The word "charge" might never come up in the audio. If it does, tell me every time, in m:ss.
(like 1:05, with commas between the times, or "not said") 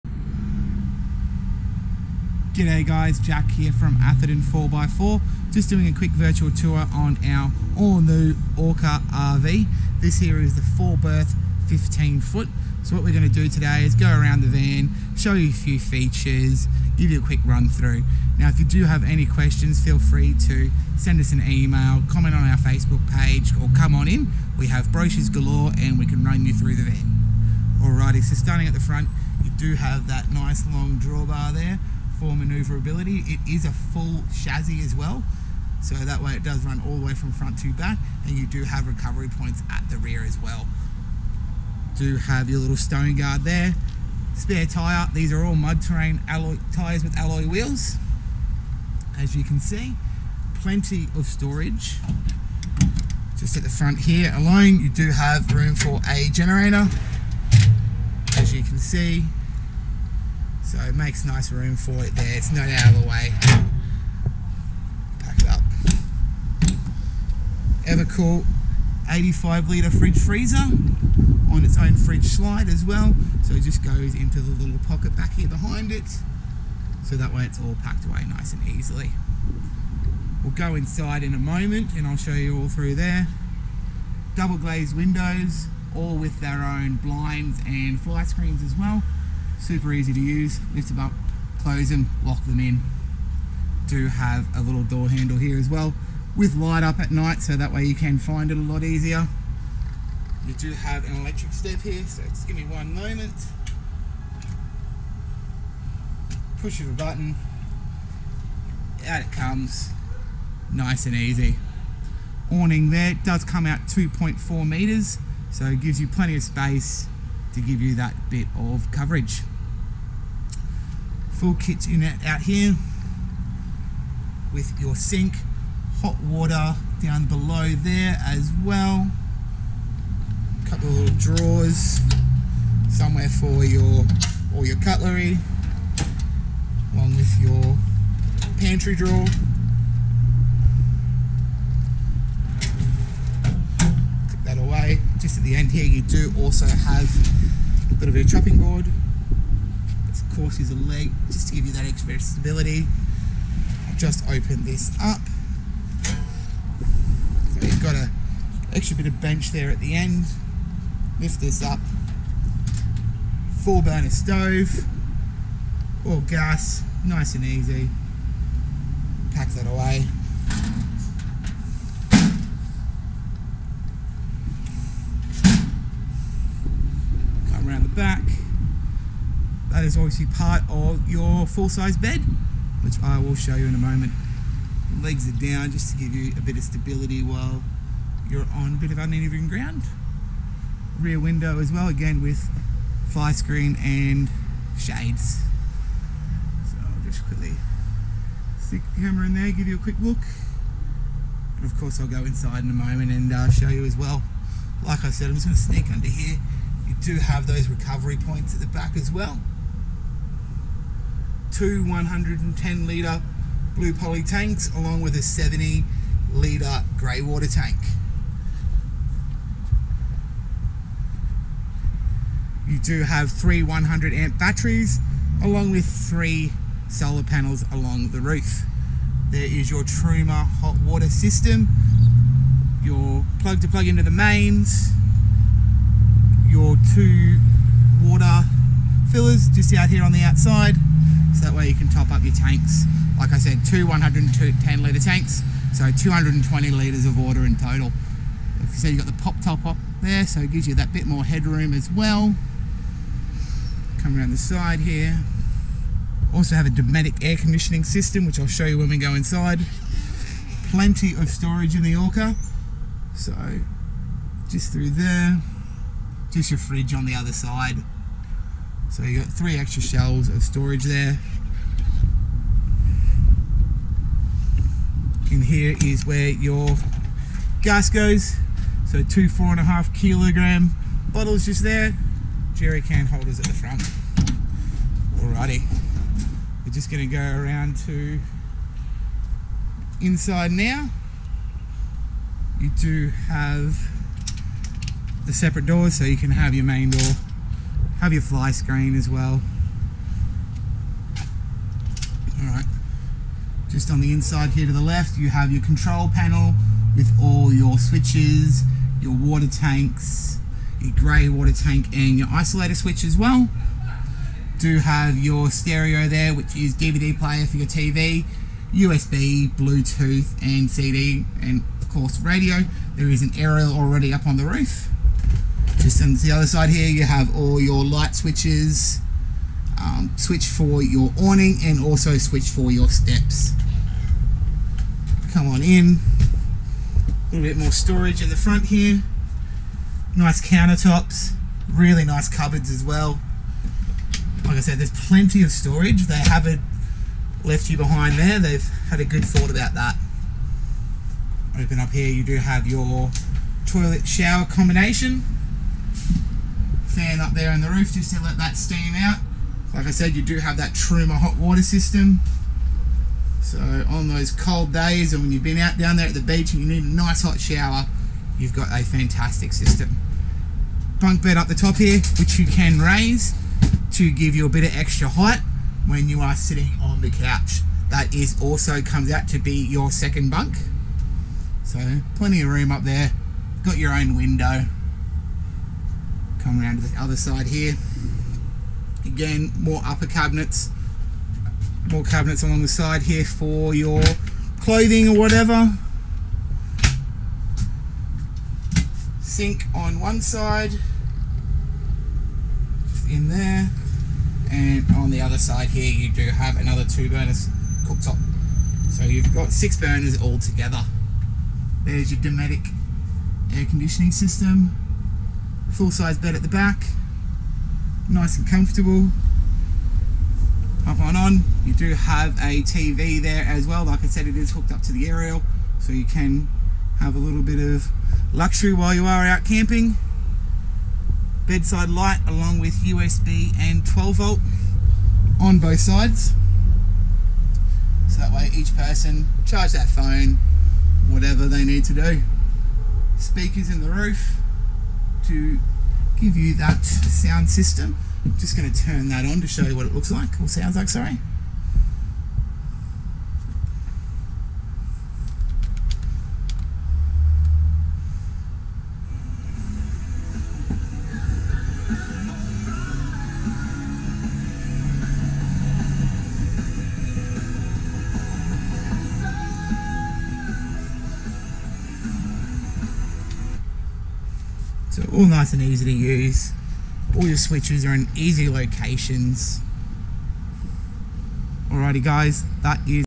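7:19.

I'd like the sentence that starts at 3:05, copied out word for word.
Legs are down just to give you a bit of stability while you're on a bit of uneven ground.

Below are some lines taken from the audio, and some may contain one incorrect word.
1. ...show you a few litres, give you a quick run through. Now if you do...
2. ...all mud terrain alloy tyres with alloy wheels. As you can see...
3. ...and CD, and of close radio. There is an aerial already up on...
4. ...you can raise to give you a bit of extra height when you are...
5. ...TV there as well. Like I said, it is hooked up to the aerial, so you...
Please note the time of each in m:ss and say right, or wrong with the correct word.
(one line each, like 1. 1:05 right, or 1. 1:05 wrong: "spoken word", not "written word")
1. 0:15 wrong: "features", not "litres"
2. 0:45 right
3. 5:20 wrong: "course", not "close"
4. 6:12 right
5. 7:02 right.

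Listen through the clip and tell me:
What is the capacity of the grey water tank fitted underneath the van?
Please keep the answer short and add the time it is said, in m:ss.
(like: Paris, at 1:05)
70 litres, at 3:35.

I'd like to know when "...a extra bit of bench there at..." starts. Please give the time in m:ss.
2:37.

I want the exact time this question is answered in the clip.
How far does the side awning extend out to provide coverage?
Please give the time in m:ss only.
1:53.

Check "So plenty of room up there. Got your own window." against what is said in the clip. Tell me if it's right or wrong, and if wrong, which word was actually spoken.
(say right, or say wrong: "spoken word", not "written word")
right.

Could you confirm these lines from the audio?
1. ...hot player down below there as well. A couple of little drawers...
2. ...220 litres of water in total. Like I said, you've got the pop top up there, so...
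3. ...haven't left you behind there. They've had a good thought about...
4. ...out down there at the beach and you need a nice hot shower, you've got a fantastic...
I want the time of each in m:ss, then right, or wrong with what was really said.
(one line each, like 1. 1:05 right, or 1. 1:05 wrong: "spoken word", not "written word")
1. 2:06 wrong: "water", not "player"
2. 4:05 right
3. 5:46 right
4. 6:05 right.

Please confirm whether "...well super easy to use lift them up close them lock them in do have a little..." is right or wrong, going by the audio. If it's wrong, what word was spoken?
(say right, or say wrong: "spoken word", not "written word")
right.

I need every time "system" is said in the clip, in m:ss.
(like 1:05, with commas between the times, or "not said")
3:51, 4:17, 6:01, 6:09, 6:54, 7:27.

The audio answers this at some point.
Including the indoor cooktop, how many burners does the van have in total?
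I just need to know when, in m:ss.
6:49.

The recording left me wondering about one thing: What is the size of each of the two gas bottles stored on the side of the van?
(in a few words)
4.5 kilograms.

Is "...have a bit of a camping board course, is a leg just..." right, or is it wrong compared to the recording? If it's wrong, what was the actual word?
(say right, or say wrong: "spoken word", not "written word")
wrong: "chopping", not "camping".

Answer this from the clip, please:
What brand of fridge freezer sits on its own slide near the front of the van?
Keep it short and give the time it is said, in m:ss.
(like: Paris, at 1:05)
Evakool, at 1:07.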